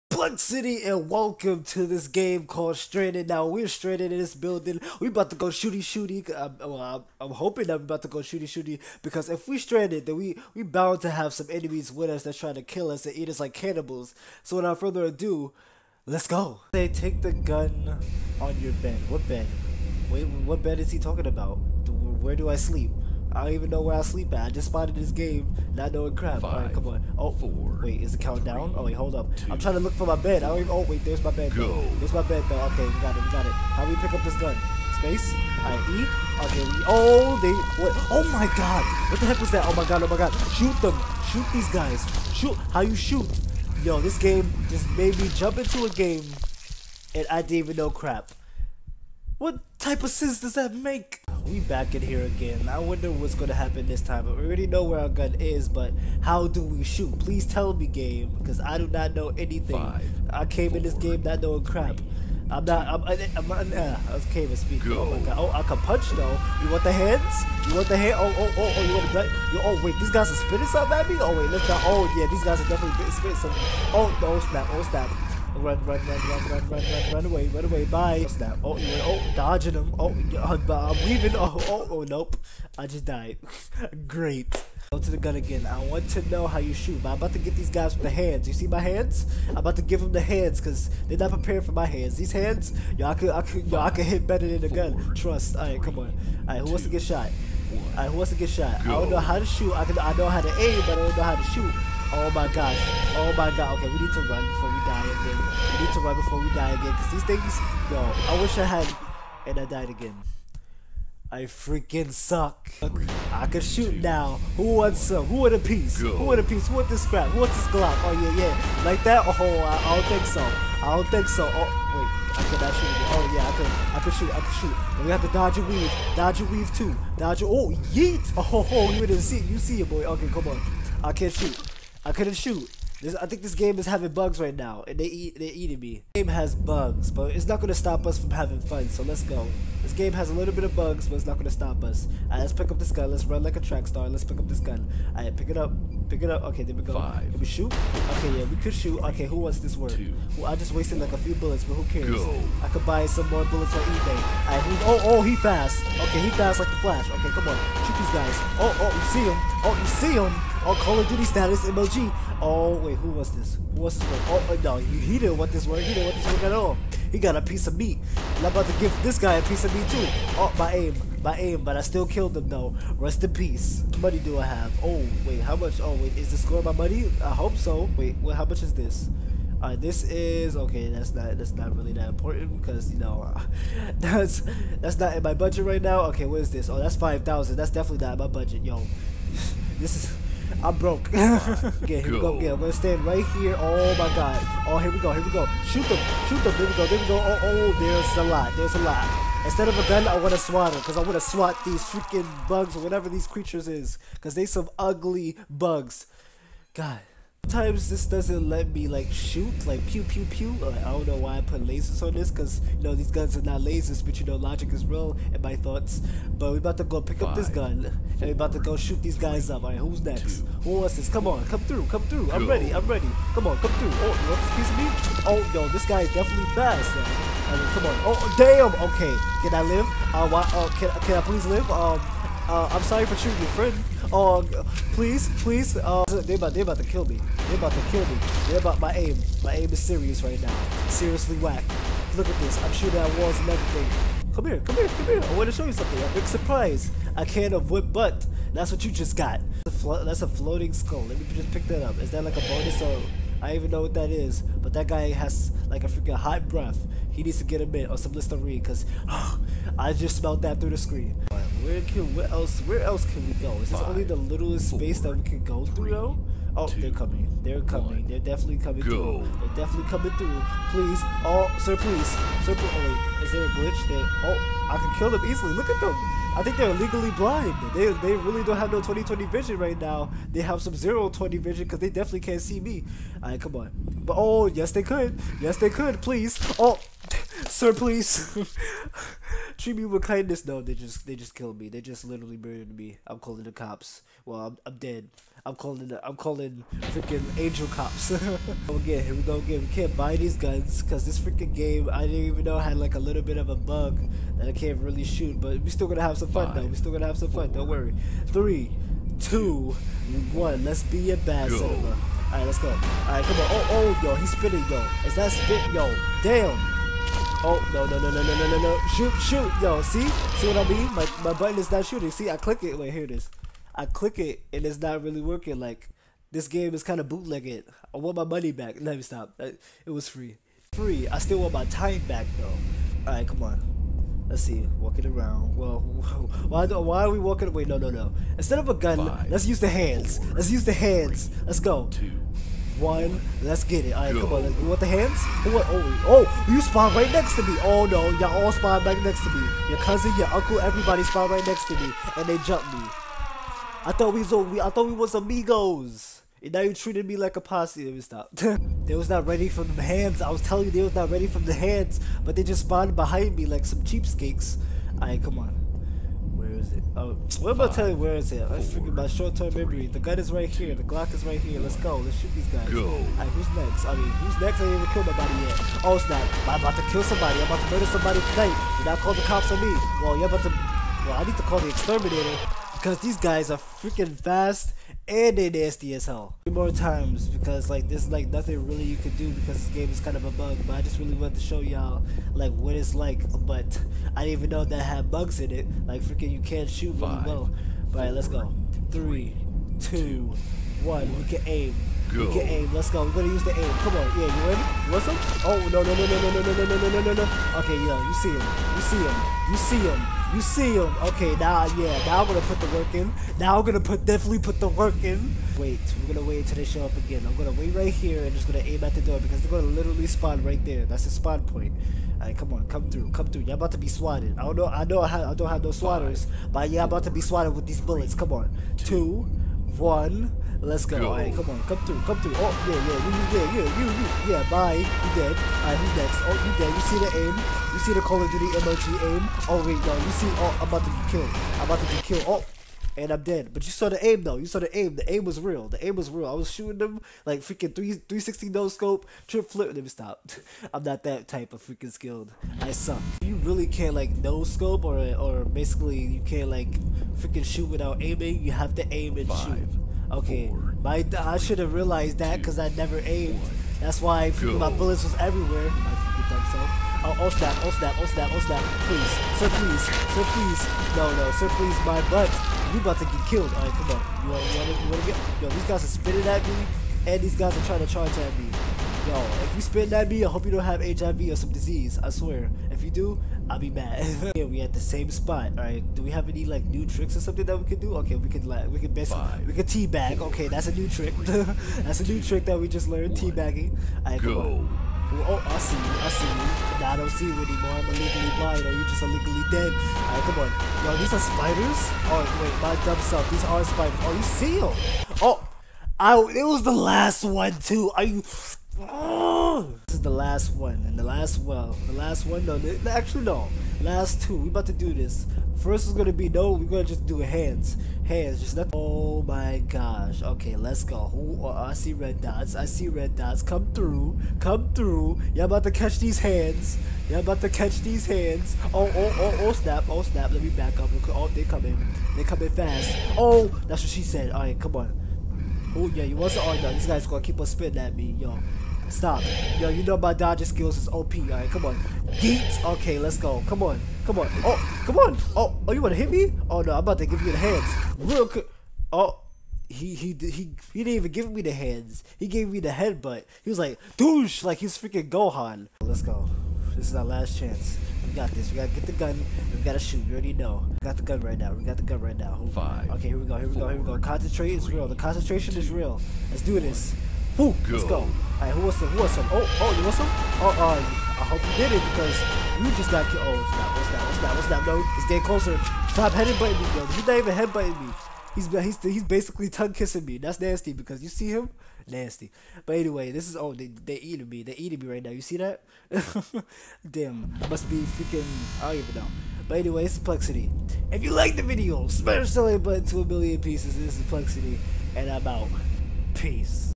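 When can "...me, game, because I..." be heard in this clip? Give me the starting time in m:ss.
0:57.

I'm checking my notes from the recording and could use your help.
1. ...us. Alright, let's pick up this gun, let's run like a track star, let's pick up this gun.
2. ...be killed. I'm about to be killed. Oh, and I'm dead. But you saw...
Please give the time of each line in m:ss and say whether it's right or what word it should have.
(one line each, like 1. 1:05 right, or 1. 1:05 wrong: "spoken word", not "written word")
1. 2:21 right
2. 7:20 right.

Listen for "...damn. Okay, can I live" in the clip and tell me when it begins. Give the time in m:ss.
3:48.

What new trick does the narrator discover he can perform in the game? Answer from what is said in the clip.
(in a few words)
teabagging.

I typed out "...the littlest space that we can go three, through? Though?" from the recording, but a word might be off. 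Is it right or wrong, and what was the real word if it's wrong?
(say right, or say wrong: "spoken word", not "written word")
right.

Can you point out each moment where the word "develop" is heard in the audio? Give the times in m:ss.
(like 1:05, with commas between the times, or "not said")
not said.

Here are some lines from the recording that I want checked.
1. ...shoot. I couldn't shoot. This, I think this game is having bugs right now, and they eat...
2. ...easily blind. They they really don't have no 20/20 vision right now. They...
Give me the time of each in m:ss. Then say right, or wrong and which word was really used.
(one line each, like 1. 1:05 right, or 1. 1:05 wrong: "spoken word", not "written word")
1. 2:11 right
2. 4:36 wrong: "legally", not "easily".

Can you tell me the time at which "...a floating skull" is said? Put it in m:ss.
4:10.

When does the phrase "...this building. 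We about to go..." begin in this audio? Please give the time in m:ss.
0:04.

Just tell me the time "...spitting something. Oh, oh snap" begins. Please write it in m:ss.
1:13.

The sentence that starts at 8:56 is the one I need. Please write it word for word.
Oh this guy's gonna keep on spitting at me, yo.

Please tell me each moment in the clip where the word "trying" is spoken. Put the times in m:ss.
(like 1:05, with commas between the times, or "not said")
0:12, 0:29, 7:57.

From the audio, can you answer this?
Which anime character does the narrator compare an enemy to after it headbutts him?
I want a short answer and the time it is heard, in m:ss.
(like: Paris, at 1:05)
Gohan, at 9:15.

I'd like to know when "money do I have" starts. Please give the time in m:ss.
2:53.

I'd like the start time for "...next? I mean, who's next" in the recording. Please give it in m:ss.
6:13.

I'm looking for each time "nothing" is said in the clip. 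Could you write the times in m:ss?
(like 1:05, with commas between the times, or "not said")
6:28, 8:38.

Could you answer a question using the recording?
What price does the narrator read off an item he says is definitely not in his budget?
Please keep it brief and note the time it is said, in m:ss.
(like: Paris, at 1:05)
5000, at 3:06.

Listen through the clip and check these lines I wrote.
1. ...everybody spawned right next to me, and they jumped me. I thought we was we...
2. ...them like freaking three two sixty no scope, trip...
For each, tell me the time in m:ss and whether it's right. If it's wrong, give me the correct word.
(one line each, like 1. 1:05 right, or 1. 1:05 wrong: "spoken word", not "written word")
1. 5:50 right
2. 7:26 wrong: "three", not "two".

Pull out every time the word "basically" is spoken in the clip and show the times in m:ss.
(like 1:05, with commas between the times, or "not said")
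7:35, 8:08, 9:39.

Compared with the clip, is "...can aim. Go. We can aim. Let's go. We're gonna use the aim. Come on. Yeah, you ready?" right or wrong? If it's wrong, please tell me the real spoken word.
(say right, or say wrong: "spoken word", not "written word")
right.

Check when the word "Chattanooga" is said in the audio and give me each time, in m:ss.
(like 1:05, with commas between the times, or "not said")
not said.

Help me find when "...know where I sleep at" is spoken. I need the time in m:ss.
0:23.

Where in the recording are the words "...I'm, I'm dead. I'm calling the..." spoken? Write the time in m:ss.
4:54.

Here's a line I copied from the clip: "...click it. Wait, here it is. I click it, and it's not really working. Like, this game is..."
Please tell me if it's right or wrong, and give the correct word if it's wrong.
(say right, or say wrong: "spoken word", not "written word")
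right.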